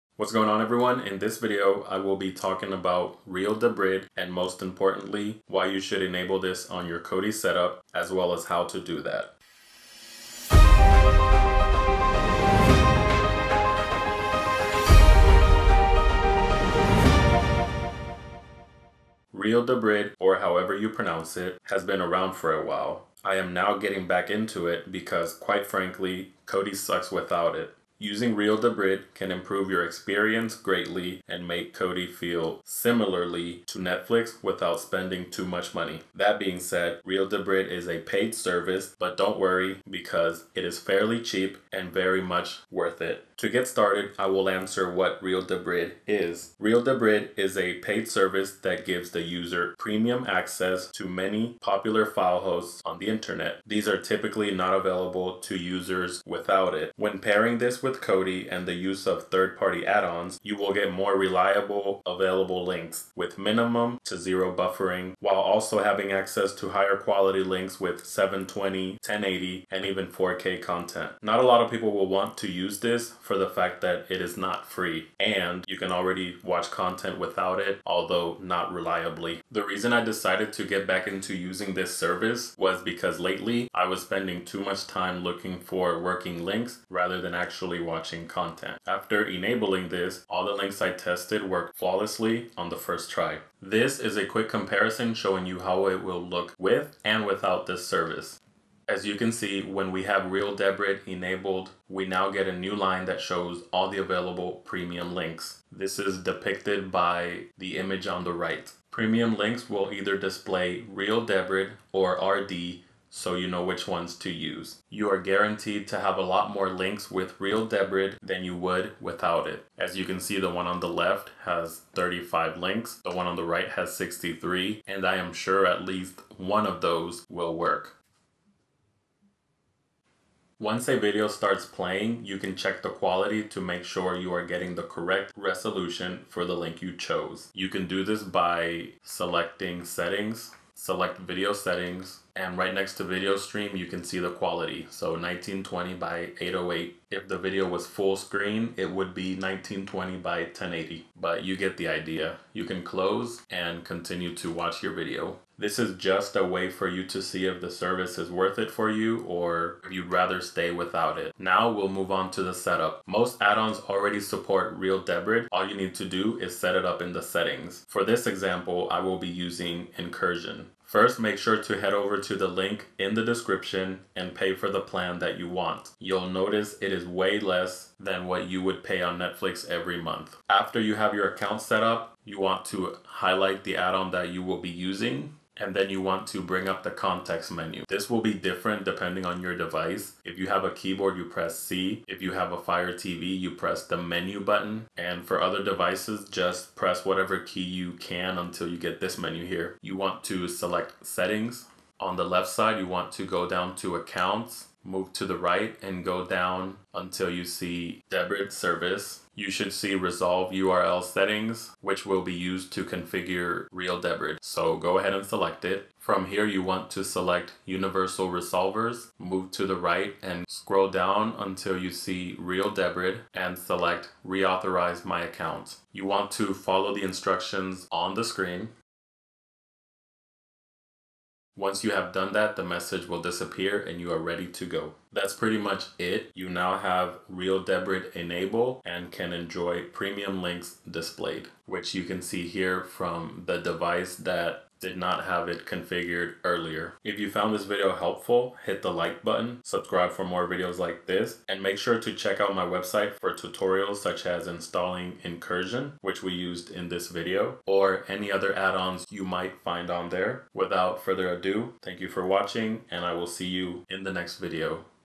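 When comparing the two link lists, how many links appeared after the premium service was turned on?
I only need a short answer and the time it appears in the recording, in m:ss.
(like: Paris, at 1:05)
63, at 2:03.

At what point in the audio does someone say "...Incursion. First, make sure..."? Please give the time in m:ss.
2:49.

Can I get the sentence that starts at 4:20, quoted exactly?
Without further ado, thank you for watching, and I will see you in the next video.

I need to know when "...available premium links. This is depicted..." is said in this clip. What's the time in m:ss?
1:43.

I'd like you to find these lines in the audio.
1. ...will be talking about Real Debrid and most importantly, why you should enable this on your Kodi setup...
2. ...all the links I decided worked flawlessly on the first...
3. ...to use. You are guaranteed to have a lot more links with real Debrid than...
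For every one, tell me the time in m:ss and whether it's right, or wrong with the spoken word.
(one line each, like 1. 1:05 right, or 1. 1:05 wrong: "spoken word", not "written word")
1. 0:01 right
2. 1:30 wrong: "tested", not "decided"
3. 1:54 right.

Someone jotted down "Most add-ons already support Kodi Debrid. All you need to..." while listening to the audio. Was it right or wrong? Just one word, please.
wrong.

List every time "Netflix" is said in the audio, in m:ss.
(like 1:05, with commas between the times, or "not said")
0:33, 2:59.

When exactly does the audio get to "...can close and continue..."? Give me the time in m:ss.
2:32.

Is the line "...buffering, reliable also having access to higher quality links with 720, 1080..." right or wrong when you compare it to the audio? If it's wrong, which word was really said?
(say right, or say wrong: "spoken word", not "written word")
wrong: "while", not "reliable".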